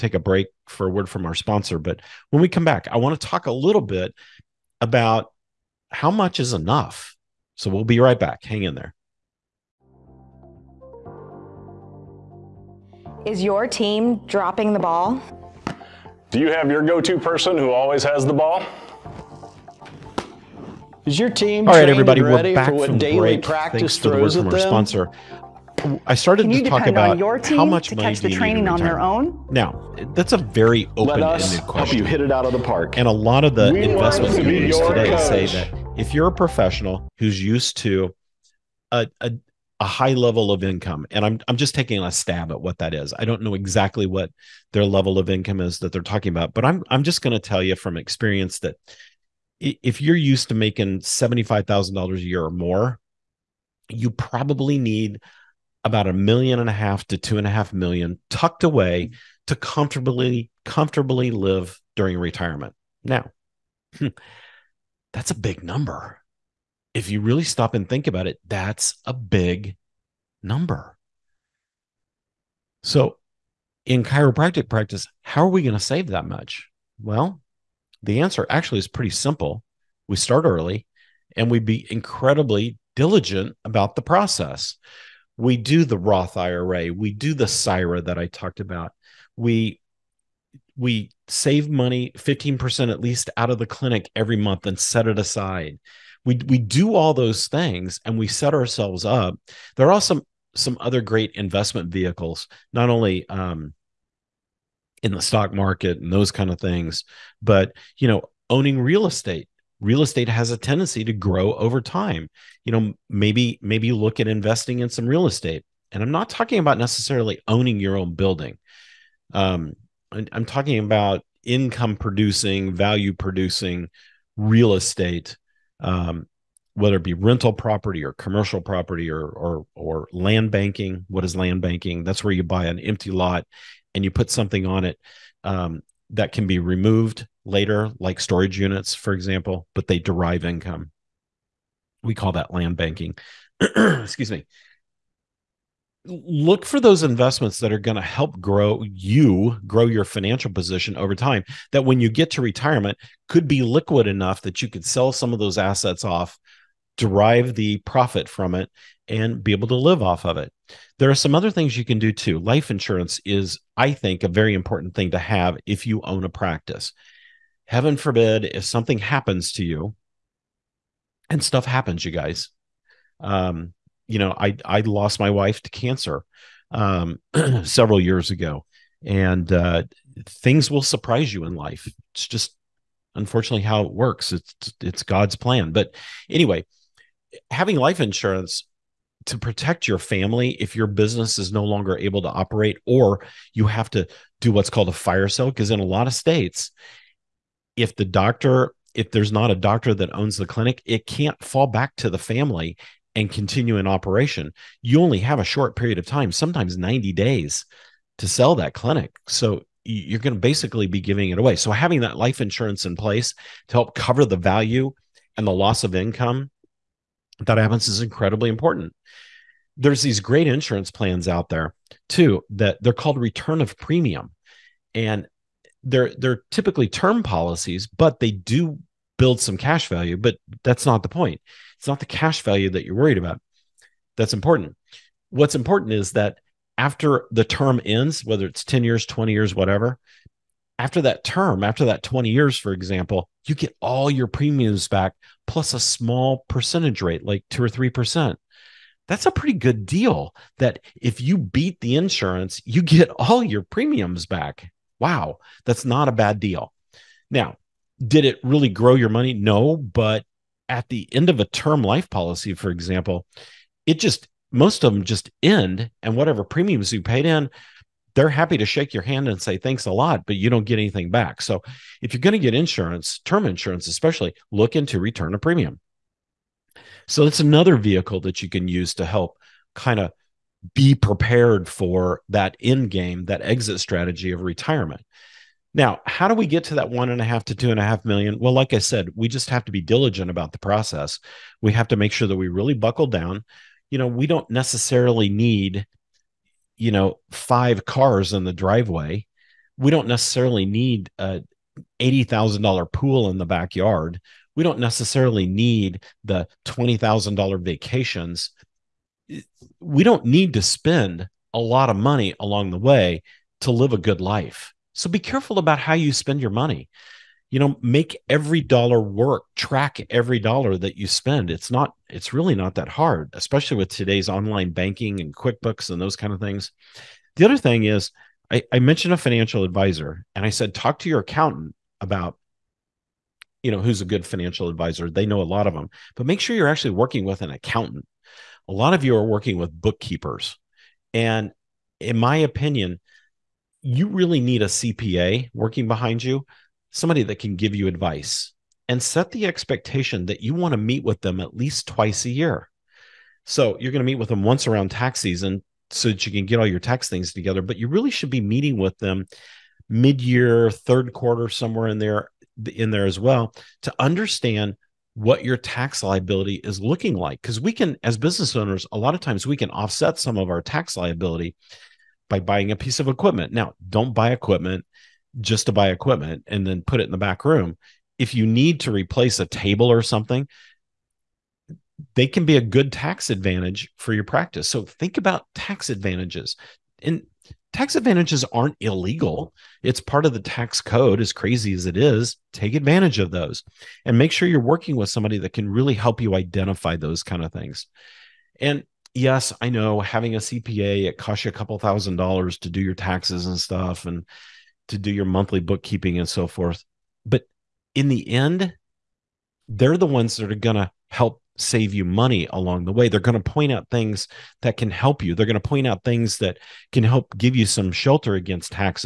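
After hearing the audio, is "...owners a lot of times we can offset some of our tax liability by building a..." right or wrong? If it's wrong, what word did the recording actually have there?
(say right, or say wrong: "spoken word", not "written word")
wrong: "buying", not "building".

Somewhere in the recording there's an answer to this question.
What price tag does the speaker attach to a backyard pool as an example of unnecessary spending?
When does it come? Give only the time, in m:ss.
5:01.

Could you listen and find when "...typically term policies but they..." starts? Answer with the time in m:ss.
3:46.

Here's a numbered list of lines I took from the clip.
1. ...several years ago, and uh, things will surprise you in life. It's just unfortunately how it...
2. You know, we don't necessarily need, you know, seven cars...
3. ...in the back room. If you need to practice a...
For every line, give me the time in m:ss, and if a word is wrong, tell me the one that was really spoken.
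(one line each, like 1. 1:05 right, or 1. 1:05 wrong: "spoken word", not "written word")
1. 2:57 right
2. 4:53 wrong: "five", not "seven"
3. 6:17 wrong: "replace", not "practice".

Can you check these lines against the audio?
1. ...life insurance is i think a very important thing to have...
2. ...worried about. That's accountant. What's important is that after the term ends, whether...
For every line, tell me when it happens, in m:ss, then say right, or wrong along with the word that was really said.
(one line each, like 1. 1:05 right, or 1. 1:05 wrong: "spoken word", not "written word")
1. 2:42 right
2. 3:52 wrong: "important", not "accountant".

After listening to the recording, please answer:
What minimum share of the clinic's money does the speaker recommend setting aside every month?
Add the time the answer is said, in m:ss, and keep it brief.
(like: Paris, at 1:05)
15%, at 1:32.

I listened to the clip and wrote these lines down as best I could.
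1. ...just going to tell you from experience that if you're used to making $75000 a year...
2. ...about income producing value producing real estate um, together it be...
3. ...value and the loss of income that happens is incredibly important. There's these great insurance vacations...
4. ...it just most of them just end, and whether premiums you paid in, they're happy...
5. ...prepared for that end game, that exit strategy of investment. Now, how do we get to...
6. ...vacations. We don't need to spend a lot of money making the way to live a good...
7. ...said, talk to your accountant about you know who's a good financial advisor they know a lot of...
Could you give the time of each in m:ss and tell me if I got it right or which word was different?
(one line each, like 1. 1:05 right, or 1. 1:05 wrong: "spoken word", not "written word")
1. 0:47 right
2. 2:00 wrong: "whether", not "together"
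3. 3:34 wrong: "plans", not "vacations"
4. 4:23 wrong: "whatever", not "whether"
5. 4:40 wrong: "retirement", not "investment"
6. 5:07 wrong: "along", not "making"
7. 5:30 right.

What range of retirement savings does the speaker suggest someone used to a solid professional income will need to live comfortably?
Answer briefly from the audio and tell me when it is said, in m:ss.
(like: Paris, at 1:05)
1.5 to 2.5 million, at 0:56.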